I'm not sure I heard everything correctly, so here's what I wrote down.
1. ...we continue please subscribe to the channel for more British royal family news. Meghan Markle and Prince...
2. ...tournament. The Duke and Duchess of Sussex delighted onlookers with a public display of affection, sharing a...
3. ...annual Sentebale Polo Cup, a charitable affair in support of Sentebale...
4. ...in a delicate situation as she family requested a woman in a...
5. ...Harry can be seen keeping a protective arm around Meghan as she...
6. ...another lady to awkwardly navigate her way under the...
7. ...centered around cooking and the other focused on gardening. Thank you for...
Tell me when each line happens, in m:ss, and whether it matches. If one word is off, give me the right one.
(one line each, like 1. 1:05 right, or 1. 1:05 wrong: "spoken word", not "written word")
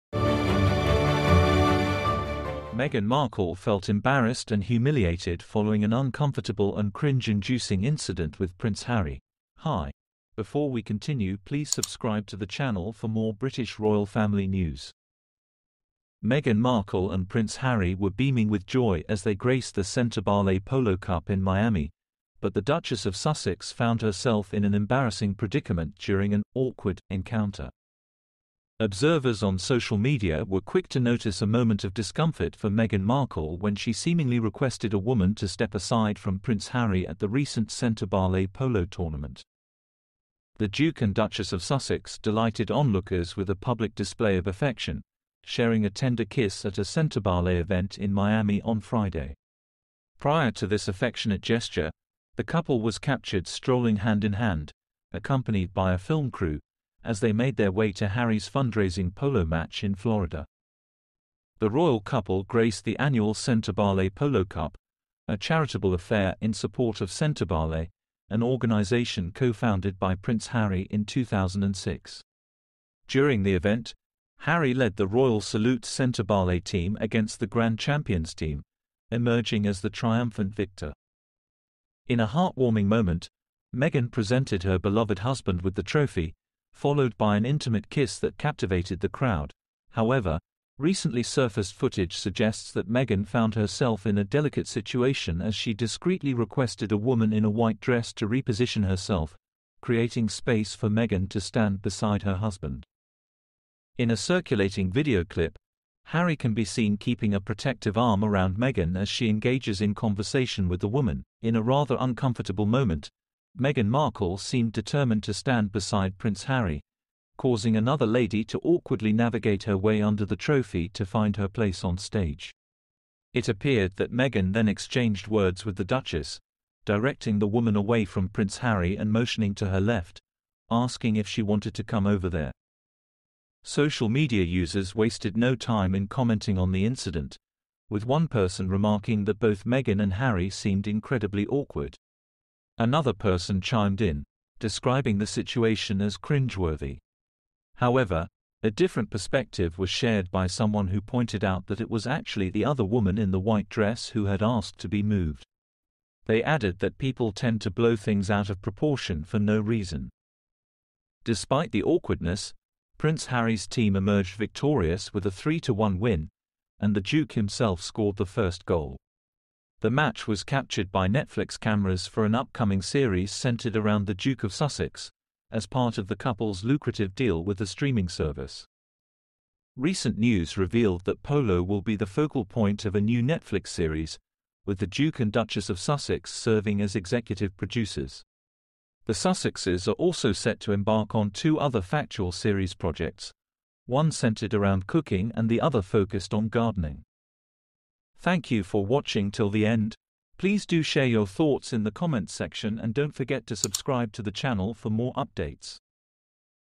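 1. 0:10 right
2. 0:38 right
3. 1:02 right
4. 1:34 wrong: "discreetly", not "family"
5. 1:46 right
6. 1:57 right
7. 3:14 right.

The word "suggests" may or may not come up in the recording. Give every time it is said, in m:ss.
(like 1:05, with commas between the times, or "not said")
1:32.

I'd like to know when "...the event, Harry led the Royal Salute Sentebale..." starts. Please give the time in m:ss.
1:13.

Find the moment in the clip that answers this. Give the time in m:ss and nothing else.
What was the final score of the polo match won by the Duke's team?
2:45.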